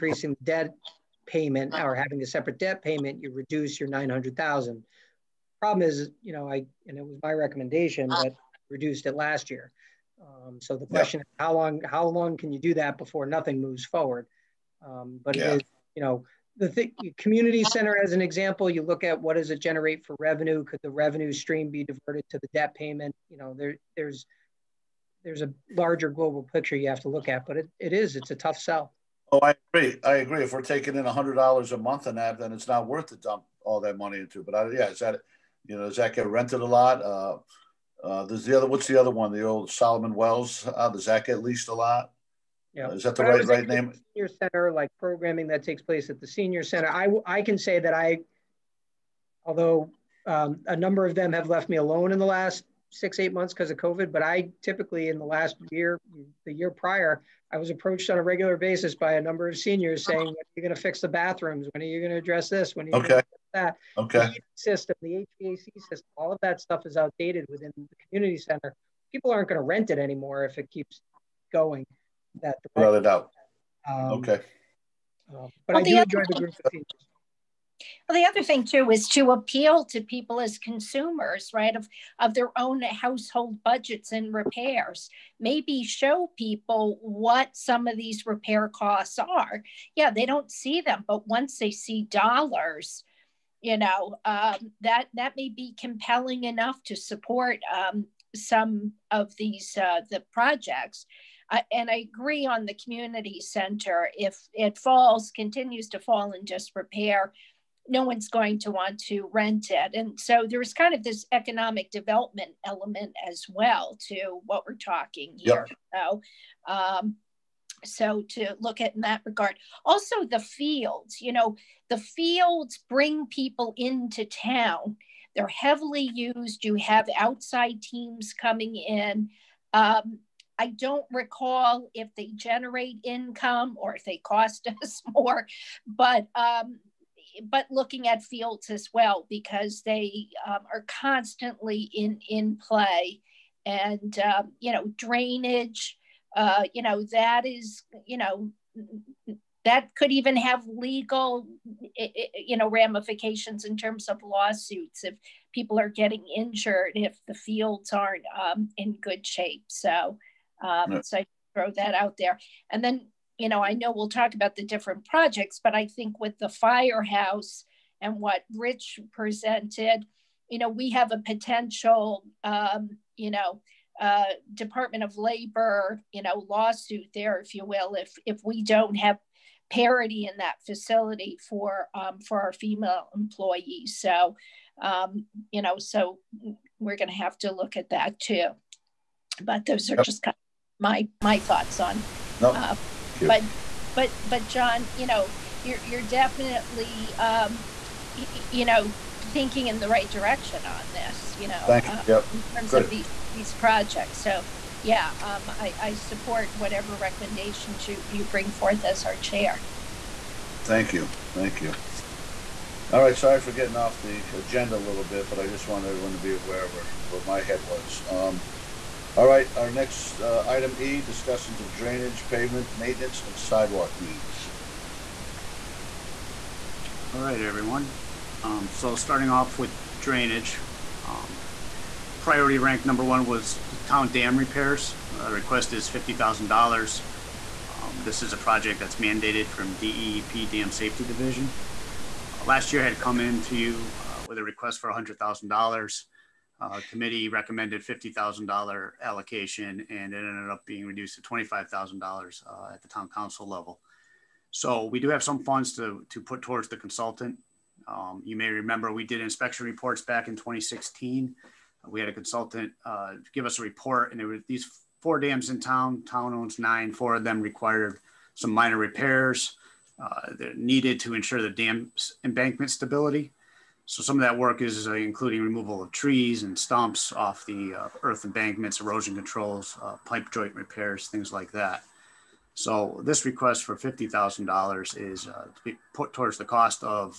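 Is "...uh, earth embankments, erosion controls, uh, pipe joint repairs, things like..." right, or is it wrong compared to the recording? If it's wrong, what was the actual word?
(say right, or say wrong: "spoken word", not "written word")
right.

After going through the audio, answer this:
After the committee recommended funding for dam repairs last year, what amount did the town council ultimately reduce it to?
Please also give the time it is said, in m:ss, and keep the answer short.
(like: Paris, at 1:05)
$25,000, at 4:11.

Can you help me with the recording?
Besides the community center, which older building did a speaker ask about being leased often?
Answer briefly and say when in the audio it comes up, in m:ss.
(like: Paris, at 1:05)
Solomon Welles, at 0:39.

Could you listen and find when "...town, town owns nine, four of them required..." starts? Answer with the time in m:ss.
4:25.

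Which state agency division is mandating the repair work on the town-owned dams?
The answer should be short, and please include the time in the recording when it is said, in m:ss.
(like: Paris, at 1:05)
DEEP Dam Safety Division, at 3:59.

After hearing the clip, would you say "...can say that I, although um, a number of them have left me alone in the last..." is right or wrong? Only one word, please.
right.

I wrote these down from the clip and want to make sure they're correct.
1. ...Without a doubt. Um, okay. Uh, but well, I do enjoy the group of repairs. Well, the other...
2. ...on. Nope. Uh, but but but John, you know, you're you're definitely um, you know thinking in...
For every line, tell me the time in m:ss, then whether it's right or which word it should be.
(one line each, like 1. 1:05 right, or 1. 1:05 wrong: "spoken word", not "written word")
1. 1:12 wrong: "seniors", not "repairs"
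2. 3:11 right.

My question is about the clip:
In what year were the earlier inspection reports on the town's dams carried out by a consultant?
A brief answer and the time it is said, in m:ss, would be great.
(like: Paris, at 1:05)
2016, at 4:20.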